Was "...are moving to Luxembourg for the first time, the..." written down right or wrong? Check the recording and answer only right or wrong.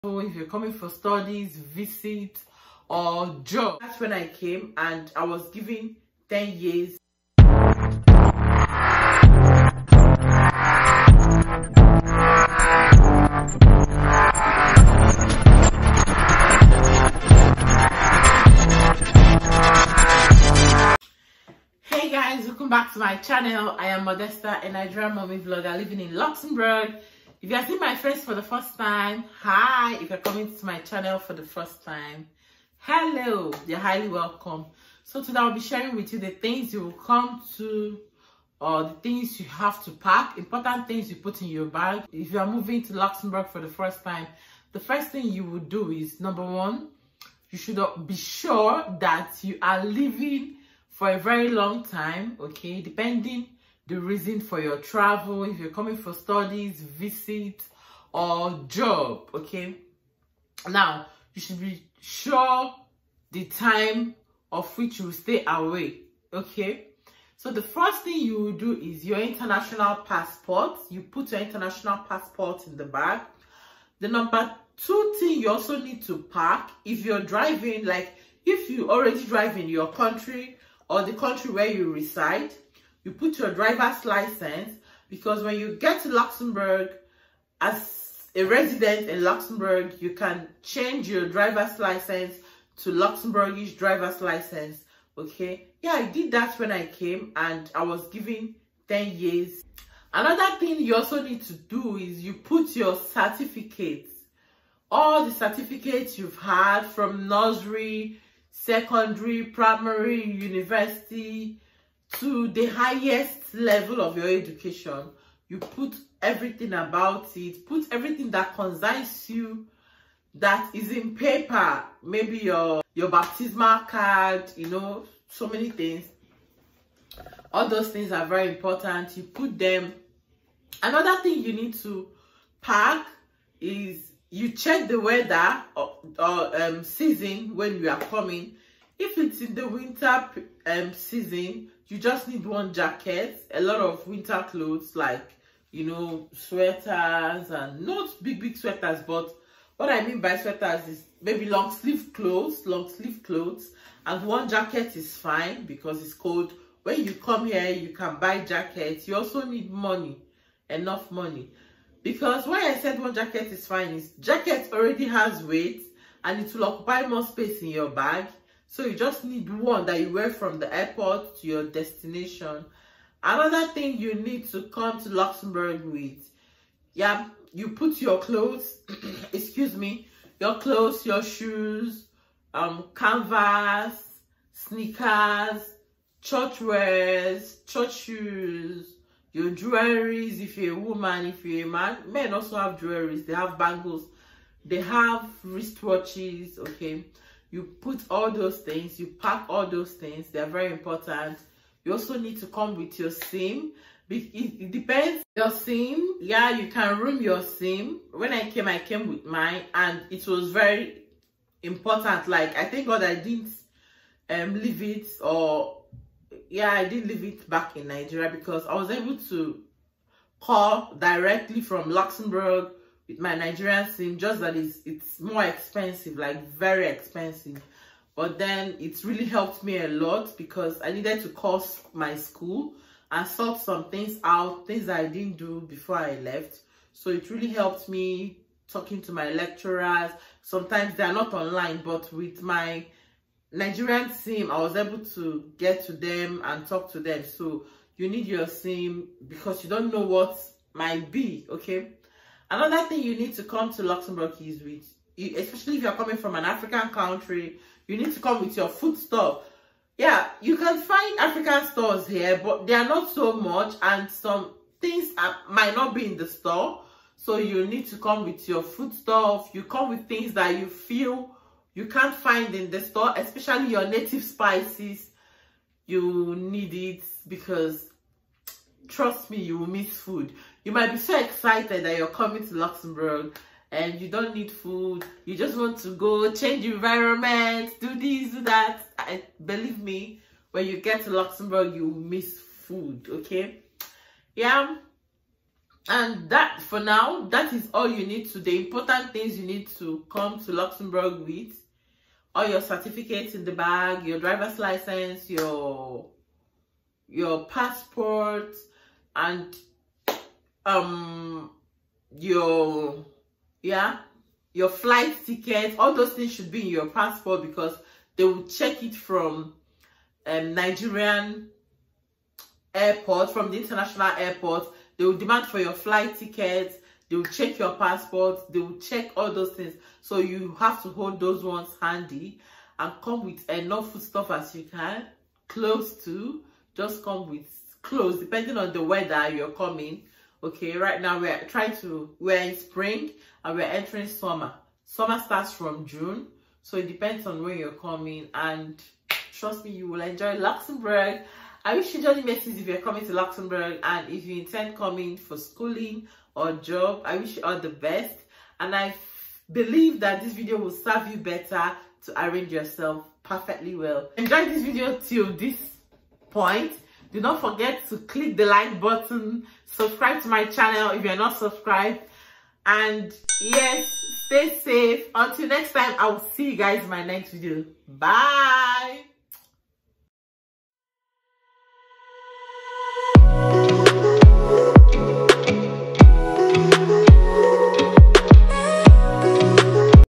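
right.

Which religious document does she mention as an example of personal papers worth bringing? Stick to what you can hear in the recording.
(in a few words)
baptismal card.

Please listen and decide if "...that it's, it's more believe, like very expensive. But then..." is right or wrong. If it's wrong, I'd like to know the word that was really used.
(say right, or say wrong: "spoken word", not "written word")
wrong: "expensive", not "believe".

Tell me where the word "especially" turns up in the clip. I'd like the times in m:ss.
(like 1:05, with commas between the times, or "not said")
4:15, 4:33.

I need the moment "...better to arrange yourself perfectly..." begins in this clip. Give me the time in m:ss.
6:01.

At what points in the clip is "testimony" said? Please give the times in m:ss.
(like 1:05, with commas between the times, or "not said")
not said.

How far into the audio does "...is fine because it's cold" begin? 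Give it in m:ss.
2:34.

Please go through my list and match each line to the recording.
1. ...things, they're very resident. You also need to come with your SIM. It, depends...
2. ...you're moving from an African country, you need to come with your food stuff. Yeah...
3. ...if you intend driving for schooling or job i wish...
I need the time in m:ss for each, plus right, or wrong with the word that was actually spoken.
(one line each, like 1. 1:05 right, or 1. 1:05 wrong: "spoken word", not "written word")
1. 3:19 wrong: "important", not "resident"
2. 4:15 wrong: "coming", not "moving"
3. 5:54 wrong: "coming", not "driving".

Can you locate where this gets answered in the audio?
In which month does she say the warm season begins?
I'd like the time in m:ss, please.
5:45.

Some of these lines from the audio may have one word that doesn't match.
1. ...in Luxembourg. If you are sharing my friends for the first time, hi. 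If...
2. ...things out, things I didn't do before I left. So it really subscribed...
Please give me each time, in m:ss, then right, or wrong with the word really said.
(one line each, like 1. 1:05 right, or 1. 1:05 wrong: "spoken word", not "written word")
1. 0:25 wrong: "seeing", not "sharing"
2. 3:53 wrong: "helped", not "subscribed".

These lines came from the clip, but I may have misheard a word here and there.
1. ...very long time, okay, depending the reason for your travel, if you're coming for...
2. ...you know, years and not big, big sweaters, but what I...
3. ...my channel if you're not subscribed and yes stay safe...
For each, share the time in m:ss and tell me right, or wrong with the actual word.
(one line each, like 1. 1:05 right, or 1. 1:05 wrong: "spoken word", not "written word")
1. 0:51 right
2. 2:25 wrong: "sweaters", not "years"
3. 6:10 right.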